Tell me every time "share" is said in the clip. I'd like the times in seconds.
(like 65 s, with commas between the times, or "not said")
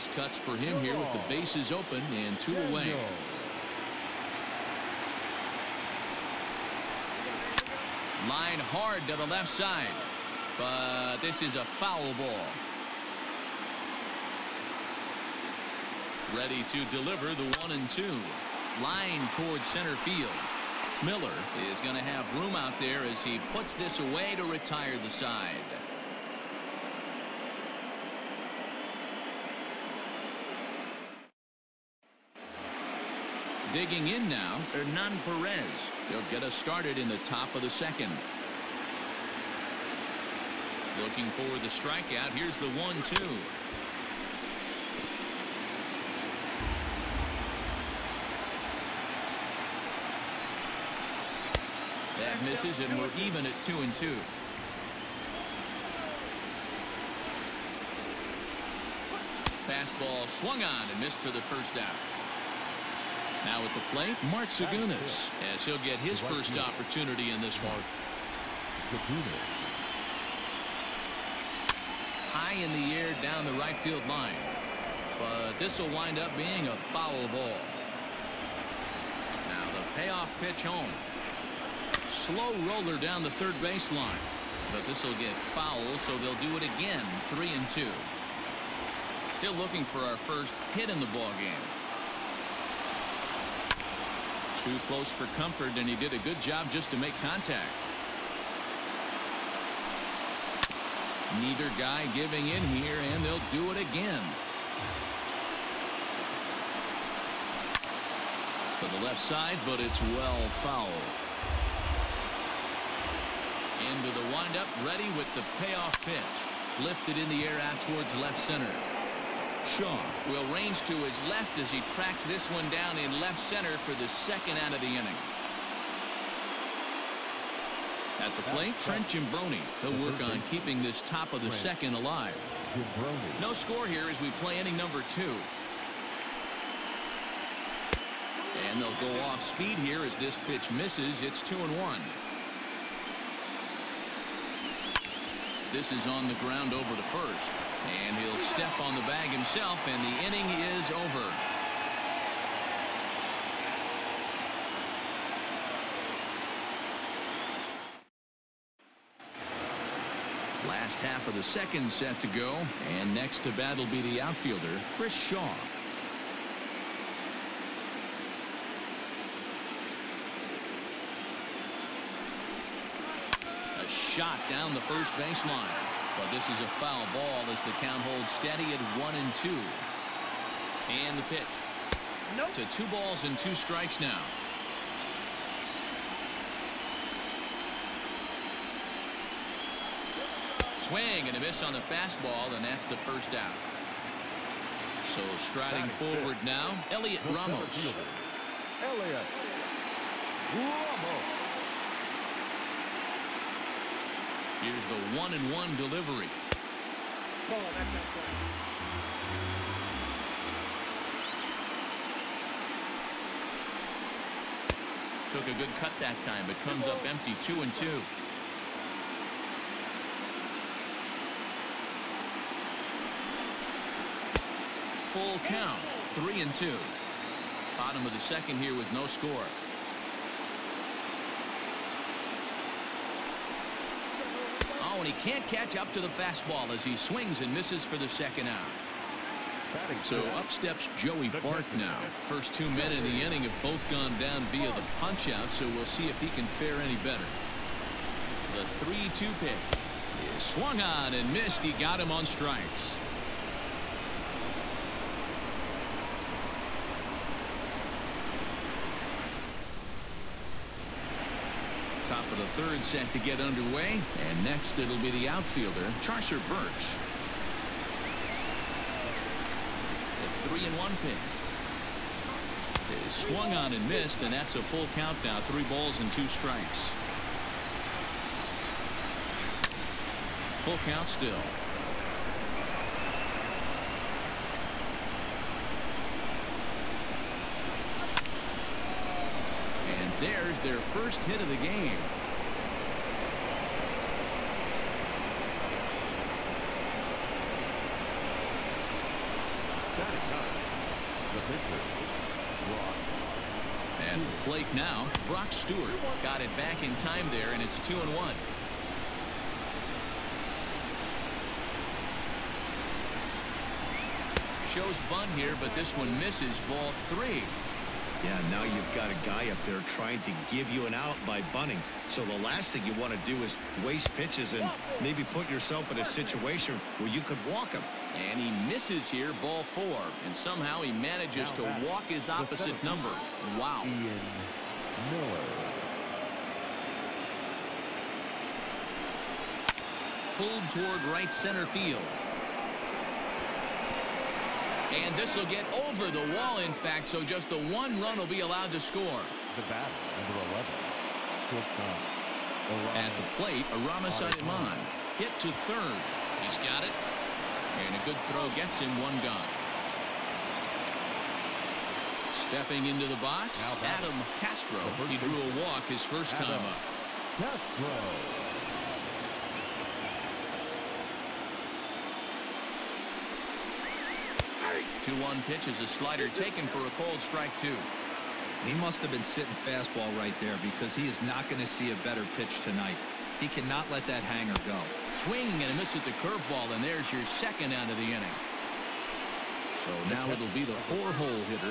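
not said.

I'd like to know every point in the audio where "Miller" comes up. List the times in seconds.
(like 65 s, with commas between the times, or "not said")
21 s, 335 s.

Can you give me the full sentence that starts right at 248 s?
The 3 2 pitch is swung on and missed.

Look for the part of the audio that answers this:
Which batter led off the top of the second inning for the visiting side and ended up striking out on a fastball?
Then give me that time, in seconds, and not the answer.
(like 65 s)
34 s.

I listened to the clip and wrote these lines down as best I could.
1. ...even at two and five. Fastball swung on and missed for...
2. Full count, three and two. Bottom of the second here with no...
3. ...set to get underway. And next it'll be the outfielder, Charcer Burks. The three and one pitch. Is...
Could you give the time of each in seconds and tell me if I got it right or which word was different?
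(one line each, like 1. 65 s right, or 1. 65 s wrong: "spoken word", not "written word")
1. 53 s wrong: "two", not "five"
2. 225 s right
3. 262 s right.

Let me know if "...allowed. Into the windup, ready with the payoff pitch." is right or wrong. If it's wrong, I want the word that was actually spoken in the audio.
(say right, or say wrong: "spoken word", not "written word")
wrong: "fouled", not "allowed".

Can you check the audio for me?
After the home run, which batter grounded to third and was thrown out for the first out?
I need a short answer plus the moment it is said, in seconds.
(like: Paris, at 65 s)
Aramis Ademan, at 353 s.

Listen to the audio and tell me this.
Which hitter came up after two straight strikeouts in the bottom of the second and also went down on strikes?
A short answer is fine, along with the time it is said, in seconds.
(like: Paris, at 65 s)
Joey Bart, at 240 s.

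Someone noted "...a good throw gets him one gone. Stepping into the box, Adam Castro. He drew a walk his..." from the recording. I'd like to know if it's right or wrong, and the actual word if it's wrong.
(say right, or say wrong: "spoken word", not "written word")
right.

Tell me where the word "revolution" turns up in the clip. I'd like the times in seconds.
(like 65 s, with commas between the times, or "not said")
not said.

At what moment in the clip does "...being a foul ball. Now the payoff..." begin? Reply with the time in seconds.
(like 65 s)
76 s.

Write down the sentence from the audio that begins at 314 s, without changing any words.
Shows bunt here, but this one misses ball three.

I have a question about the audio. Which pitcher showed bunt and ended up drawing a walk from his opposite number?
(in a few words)
Brock Stewart.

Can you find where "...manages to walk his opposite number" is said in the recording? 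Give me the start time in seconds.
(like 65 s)
330 s.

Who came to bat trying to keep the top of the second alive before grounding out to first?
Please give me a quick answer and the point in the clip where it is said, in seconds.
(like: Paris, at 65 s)
Trent Giambrone, at 128 s.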